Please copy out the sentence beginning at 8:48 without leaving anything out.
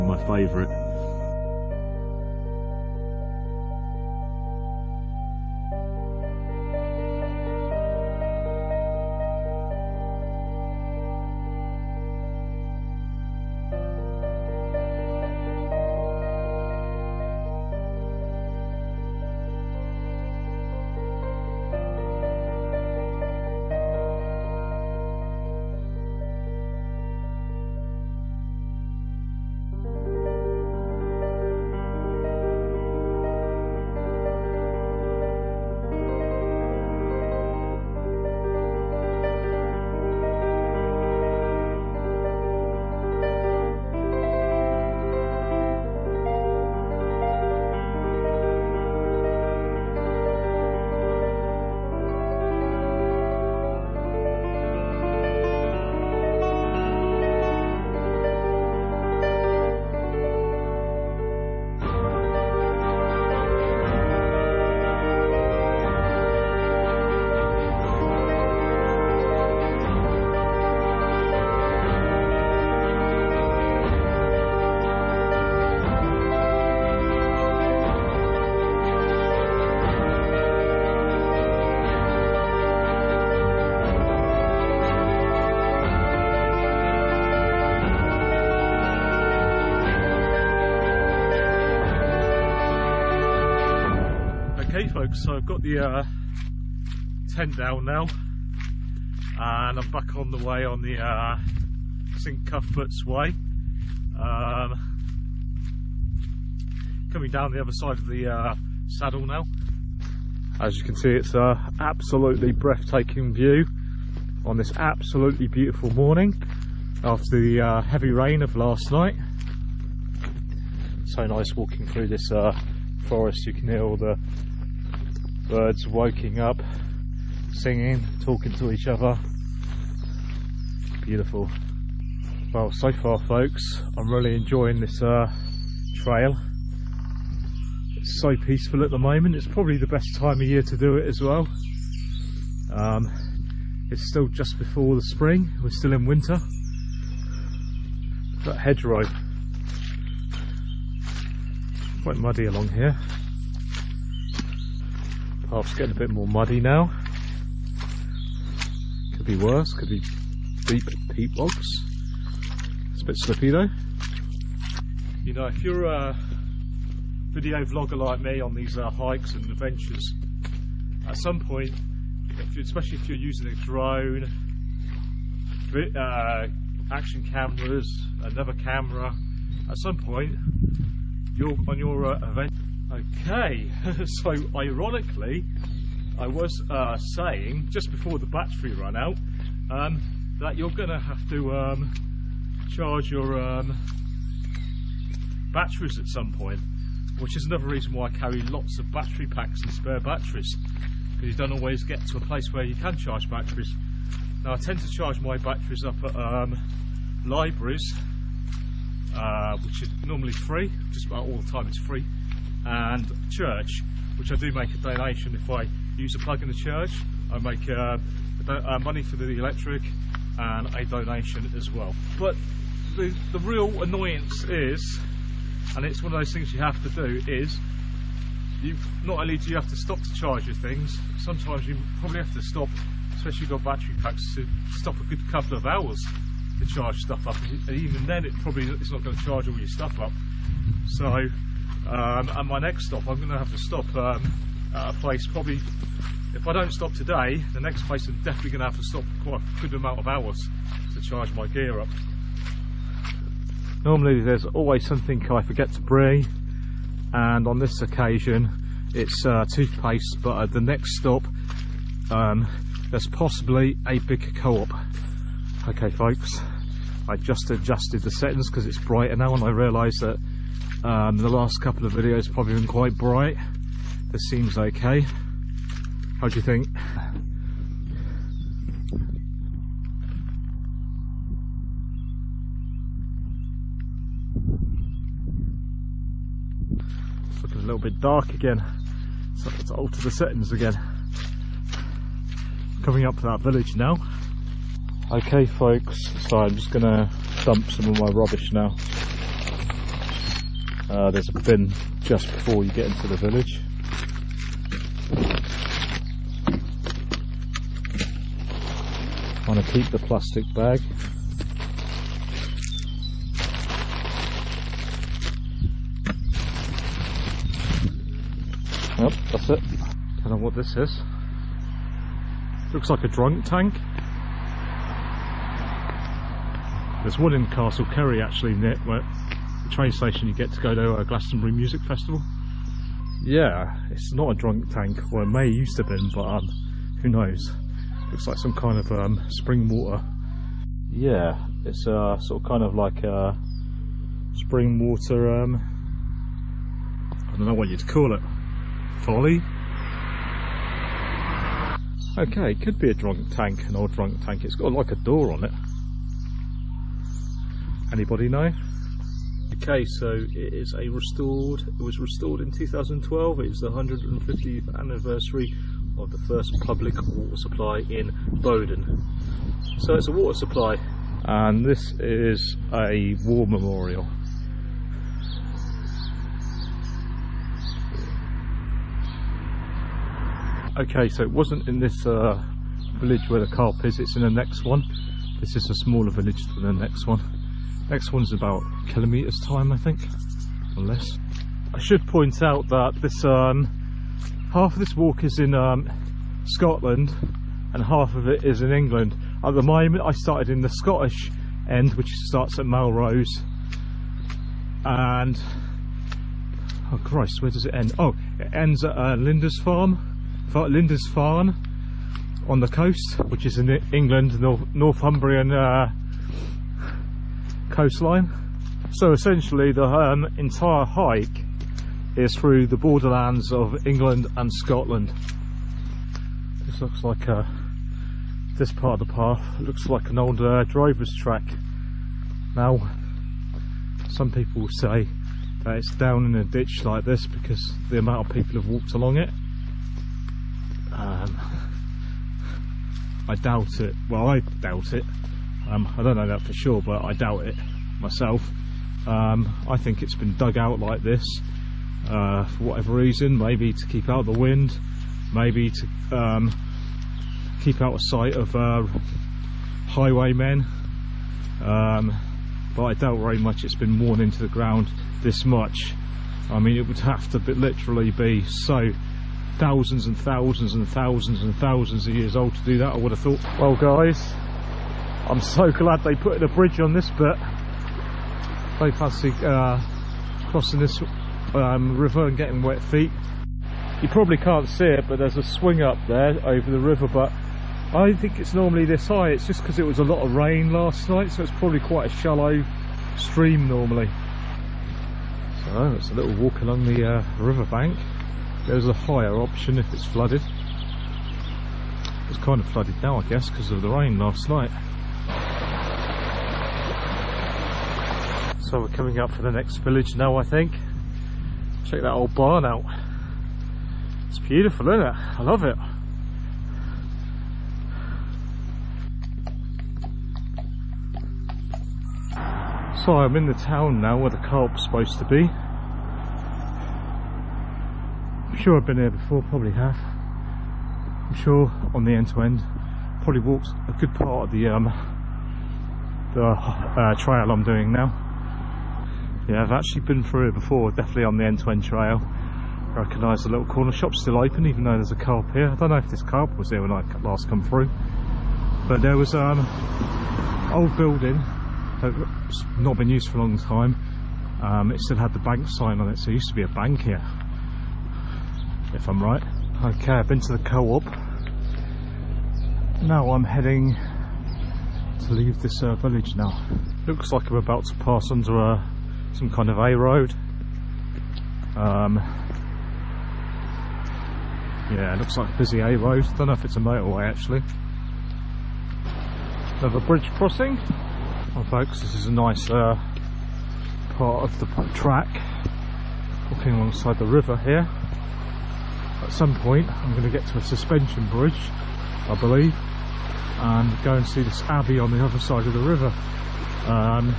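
I'm sure I've been here before, probably have.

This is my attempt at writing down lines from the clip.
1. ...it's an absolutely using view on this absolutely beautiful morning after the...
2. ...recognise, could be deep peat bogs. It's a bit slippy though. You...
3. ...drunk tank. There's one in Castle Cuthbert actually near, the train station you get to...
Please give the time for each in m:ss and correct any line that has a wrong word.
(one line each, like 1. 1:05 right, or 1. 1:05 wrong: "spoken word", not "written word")
1. 1:51 wrong: "breathtaking", not "using"
2. 2:39 wrong: "worse", not "recognise"
3. 5:23 wrong: "Cary", not "Cuthbert".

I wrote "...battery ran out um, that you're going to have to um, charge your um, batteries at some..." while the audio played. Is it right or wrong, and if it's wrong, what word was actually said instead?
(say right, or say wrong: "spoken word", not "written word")
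right.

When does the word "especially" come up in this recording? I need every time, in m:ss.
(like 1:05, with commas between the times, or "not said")
2:52, 3:53.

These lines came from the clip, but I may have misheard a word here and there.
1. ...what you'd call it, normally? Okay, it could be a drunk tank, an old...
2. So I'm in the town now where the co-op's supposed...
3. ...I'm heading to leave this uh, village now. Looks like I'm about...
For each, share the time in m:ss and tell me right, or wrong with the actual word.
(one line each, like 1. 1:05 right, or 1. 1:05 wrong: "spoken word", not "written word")
1. 5:47 wrong: "folly", not "normally"
2. 8:43 right
3. 9:23 right.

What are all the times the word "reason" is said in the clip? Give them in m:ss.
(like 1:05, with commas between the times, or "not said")
3:17, 7:32.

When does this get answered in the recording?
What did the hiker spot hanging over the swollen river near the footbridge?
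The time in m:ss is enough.
8:05.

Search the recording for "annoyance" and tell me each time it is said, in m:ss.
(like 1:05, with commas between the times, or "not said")
3:43.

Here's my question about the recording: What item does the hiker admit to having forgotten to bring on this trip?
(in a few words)
Toothpaste.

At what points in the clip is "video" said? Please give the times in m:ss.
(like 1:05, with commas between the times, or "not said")
2:47, 4:31.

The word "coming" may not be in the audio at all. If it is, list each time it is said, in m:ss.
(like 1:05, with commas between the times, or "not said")
1:47, 4:52, 8:28.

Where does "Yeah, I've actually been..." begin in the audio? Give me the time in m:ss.
8:59.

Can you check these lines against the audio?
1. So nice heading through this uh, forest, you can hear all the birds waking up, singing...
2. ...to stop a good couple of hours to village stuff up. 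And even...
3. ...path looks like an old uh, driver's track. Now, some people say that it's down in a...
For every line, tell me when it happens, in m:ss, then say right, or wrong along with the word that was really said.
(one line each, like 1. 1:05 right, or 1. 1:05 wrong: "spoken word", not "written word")
1. 2:01 wrong: "walking", not "heading"
2. 3:54 wrong: "charge", not "village"
3. 7:09 right.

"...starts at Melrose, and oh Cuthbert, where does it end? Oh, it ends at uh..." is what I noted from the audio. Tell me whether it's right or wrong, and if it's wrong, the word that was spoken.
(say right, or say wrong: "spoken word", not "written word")
wrong: "Christ", not "Cuthbert".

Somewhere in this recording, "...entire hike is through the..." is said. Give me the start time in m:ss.
7:00.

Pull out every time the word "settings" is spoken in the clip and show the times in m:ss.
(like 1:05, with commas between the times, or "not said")
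4:28, 4:50.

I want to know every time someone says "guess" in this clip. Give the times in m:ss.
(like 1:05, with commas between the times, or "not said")
8:23.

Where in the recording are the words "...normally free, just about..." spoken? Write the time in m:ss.
3:30.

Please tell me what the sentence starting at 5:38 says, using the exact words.
Looks like some kind of um, spring water.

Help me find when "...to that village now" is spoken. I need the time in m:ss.
4:53.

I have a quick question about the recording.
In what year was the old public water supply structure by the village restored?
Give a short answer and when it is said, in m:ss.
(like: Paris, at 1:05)
2012, at 6:02.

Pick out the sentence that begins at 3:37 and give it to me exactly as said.
I make uh, uh, money for the electric and a donation as well.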